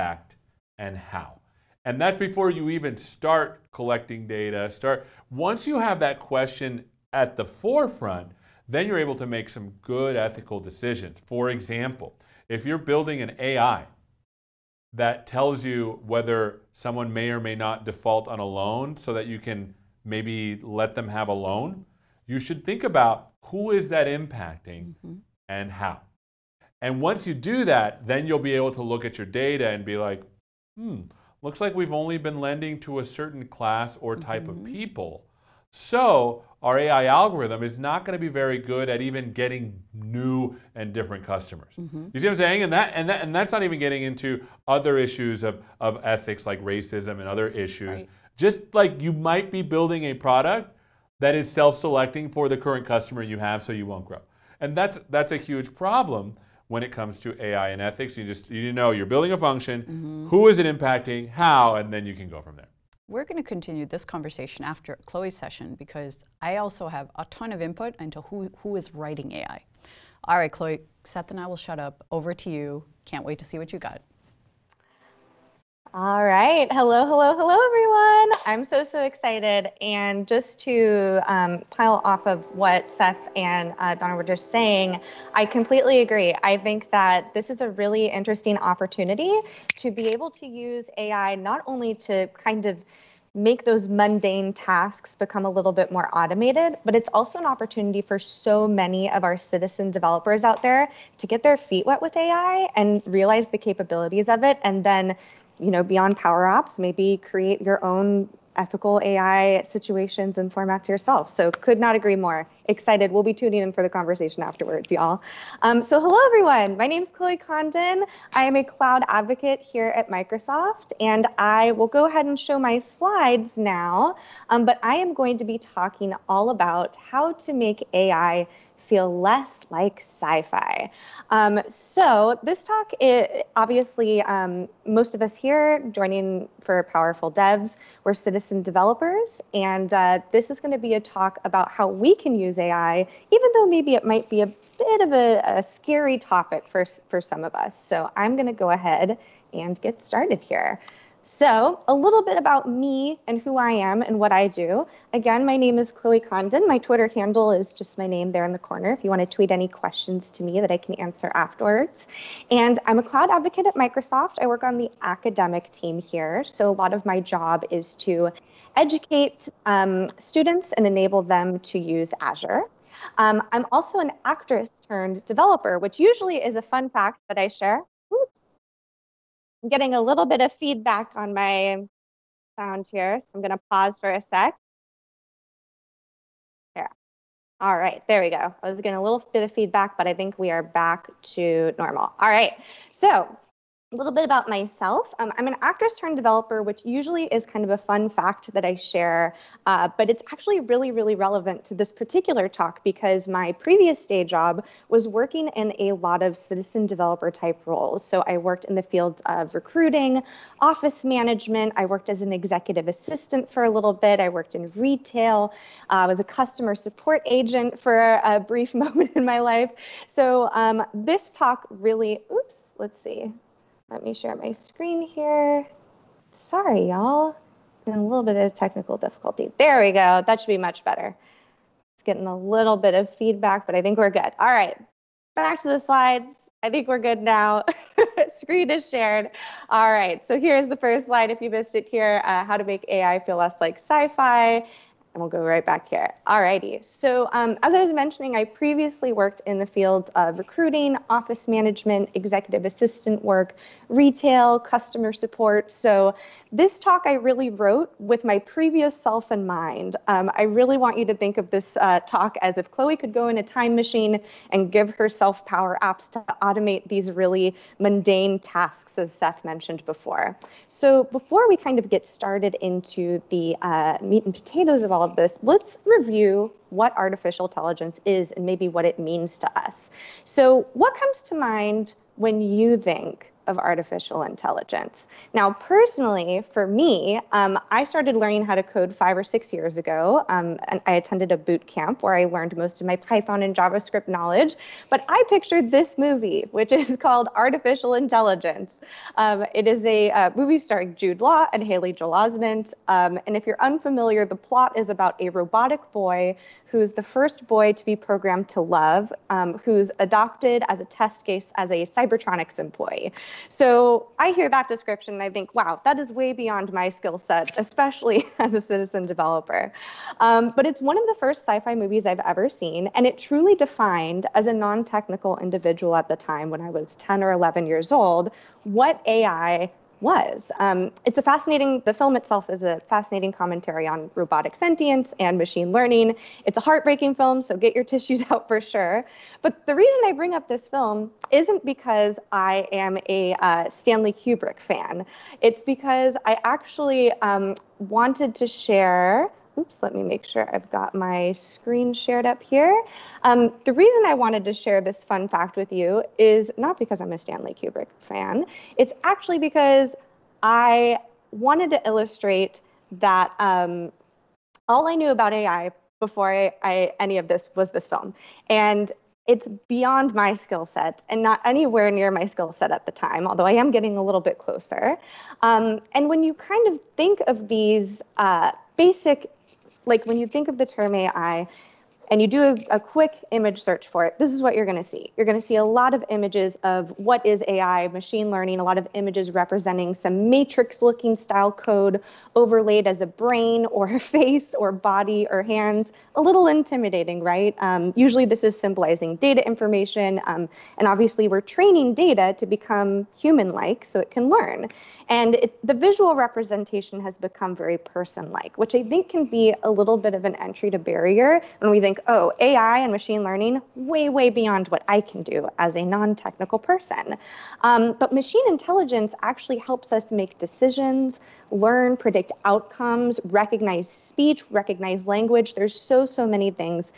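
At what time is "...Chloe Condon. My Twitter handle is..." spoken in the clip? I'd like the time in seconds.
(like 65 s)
155 s.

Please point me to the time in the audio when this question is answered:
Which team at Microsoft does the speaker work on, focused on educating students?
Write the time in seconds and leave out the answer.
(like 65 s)
165 s.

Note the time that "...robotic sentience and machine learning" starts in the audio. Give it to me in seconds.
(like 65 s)
334 s.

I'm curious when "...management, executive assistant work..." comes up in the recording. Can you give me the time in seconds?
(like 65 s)
251 s.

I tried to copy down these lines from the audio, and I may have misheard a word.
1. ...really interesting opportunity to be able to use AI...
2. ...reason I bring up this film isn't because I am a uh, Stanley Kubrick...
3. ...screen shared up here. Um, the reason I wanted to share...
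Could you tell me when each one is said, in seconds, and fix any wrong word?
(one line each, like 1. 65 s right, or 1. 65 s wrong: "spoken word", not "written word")
1. 87 s right
2. 339 s right
3. 351 s right.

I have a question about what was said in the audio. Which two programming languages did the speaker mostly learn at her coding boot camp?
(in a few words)
Python and JavaScript.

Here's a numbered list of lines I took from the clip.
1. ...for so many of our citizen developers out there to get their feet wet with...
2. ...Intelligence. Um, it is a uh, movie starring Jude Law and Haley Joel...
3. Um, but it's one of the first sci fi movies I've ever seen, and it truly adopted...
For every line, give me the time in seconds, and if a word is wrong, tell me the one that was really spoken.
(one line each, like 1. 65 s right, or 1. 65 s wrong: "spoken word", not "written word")
1. 98 s right
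2. 297 s right
3. 320 s wrong: "defined", not "adopted".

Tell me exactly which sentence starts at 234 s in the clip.
All right, back to the slides.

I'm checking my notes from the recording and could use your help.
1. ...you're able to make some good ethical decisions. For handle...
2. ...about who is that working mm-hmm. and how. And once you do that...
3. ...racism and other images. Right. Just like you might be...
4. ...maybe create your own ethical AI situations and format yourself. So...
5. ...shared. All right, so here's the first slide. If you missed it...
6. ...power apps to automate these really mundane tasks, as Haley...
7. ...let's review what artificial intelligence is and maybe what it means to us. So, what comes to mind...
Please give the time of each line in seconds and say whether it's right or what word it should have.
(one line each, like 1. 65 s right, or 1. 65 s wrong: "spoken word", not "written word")
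1. 8 s wrong: "example", not "handle"
2. 22 s wrong: "impacting", not "working"
3. 46 s wrong: "issues", not "images"
4. 106 s right
5. 238 s right
6. 265 s wrong: "Seth", not "Haley"
7. 275 s right.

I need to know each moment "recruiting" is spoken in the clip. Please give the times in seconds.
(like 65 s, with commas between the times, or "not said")
209 s, 250 s.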